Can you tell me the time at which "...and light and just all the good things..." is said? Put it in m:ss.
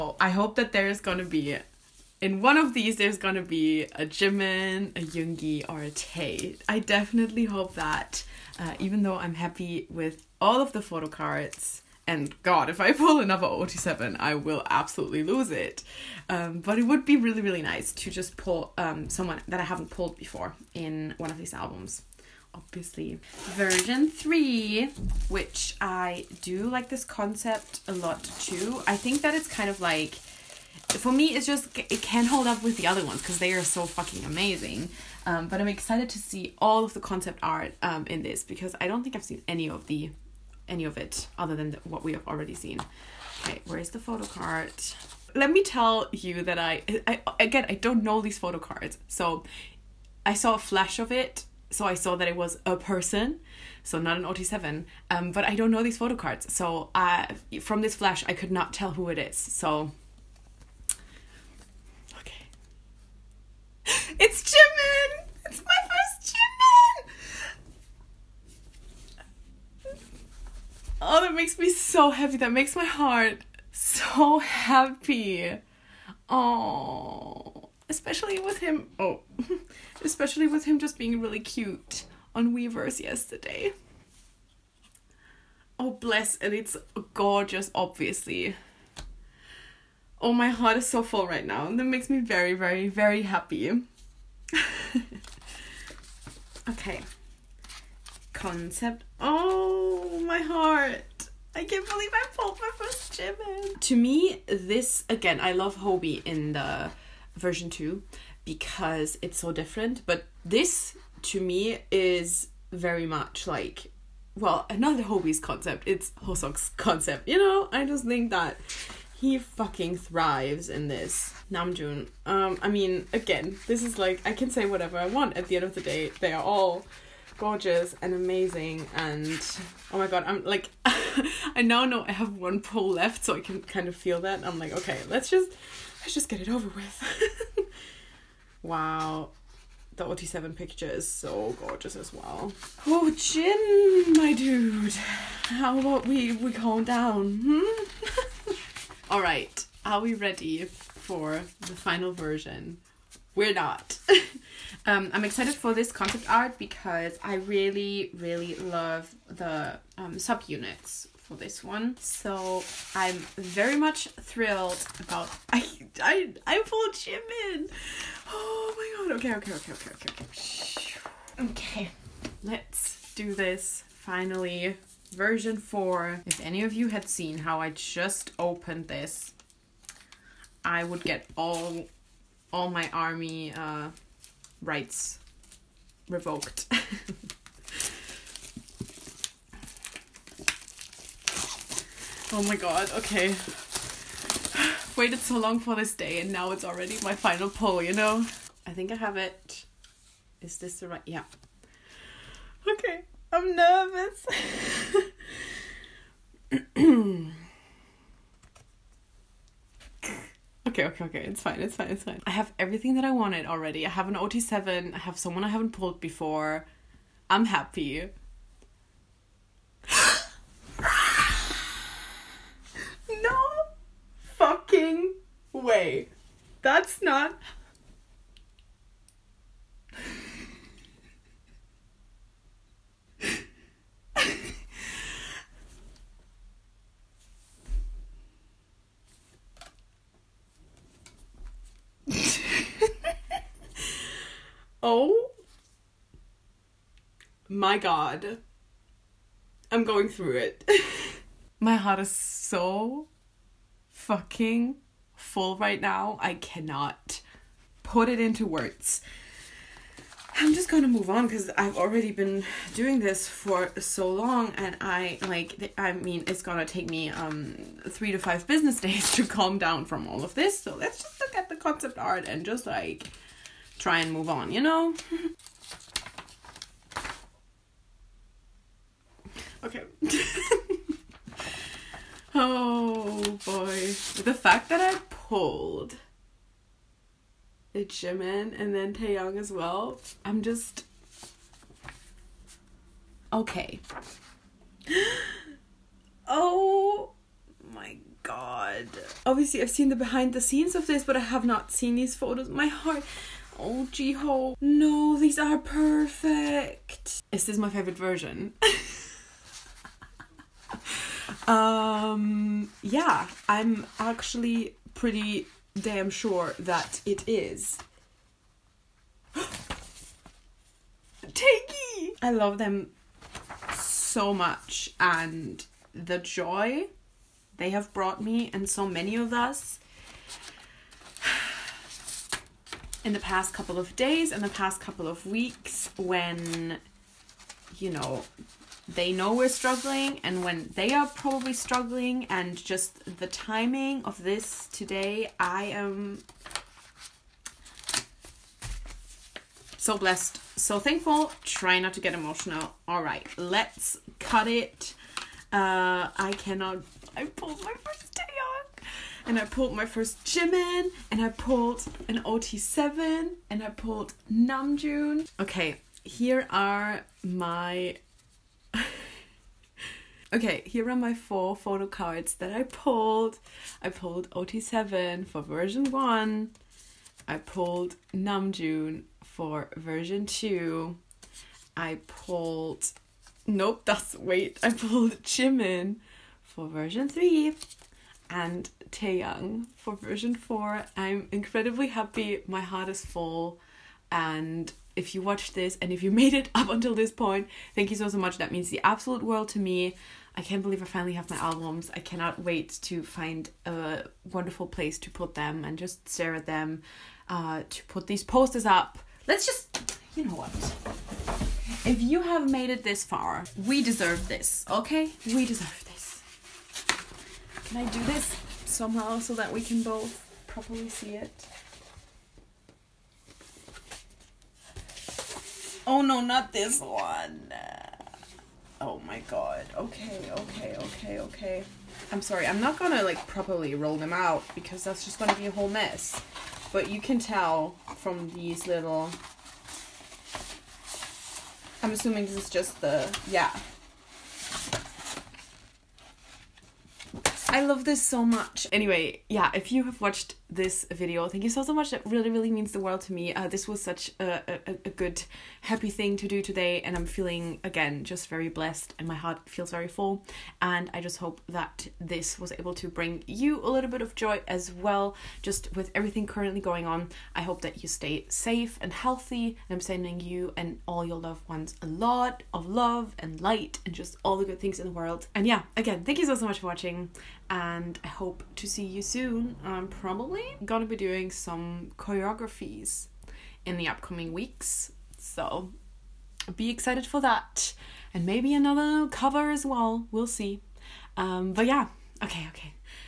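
7:53.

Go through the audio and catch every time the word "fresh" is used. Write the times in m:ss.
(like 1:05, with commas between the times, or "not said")
not said.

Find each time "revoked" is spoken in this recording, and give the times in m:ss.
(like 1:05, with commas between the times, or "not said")
3:06.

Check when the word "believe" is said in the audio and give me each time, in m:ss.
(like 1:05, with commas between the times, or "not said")
1:41, 6:40.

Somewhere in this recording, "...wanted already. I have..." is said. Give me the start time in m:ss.
3:33.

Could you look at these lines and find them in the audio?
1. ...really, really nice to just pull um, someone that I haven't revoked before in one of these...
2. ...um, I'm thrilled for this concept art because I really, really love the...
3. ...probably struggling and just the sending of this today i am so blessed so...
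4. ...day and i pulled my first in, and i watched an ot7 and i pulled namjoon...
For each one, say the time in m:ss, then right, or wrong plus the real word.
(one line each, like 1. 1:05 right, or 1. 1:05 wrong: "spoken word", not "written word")
1. 0:17 wrong: "pulled", not "revoked"
2. 2:34 wrong: "excited", not "thrilled"
3. 5:41 wrong: "timing", not "sending"
4. 5:58 wrong: "pulled", not "watched".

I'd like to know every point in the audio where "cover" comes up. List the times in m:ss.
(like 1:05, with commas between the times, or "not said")
8:09.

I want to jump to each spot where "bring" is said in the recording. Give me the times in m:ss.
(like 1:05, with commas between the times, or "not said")
7:42.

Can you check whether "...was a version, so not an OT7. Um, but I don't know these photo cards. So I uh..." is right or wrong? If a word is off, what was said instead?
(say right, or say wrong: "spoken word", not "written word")
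wrong: "person", not "version".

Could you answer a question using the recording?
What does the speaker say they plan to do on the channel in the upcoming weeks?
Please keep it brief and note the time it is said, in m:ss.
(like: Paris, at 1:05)
choreographies, at 8:01.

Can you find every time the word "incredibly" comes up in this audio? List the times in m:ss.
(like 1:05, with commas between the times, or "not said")
6:31.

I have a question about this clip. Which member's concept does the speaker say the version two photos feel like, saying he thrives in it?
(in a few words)
Hoseok.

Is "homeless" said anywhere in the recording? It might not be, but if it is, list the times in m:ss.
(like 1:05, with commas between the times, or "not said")
not said.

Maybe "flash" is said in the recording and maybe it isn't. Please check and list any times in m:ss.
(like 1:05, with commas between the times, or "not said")
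0:50, 0:57.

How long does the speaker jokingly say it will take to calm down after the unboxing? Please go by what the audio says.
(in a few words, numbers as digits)
3 to 5 business days.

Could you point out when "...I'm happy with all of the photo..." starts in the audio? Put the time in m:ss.
0:09.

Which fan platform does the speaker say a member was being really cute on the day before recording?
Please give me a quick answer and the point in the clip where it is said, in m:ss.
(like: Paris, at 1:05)
Weverse, at 1:22.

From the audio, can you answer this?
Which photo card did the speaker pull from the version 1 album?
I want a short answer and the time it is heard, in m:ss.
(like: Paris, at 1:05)
OT7, at 6:14.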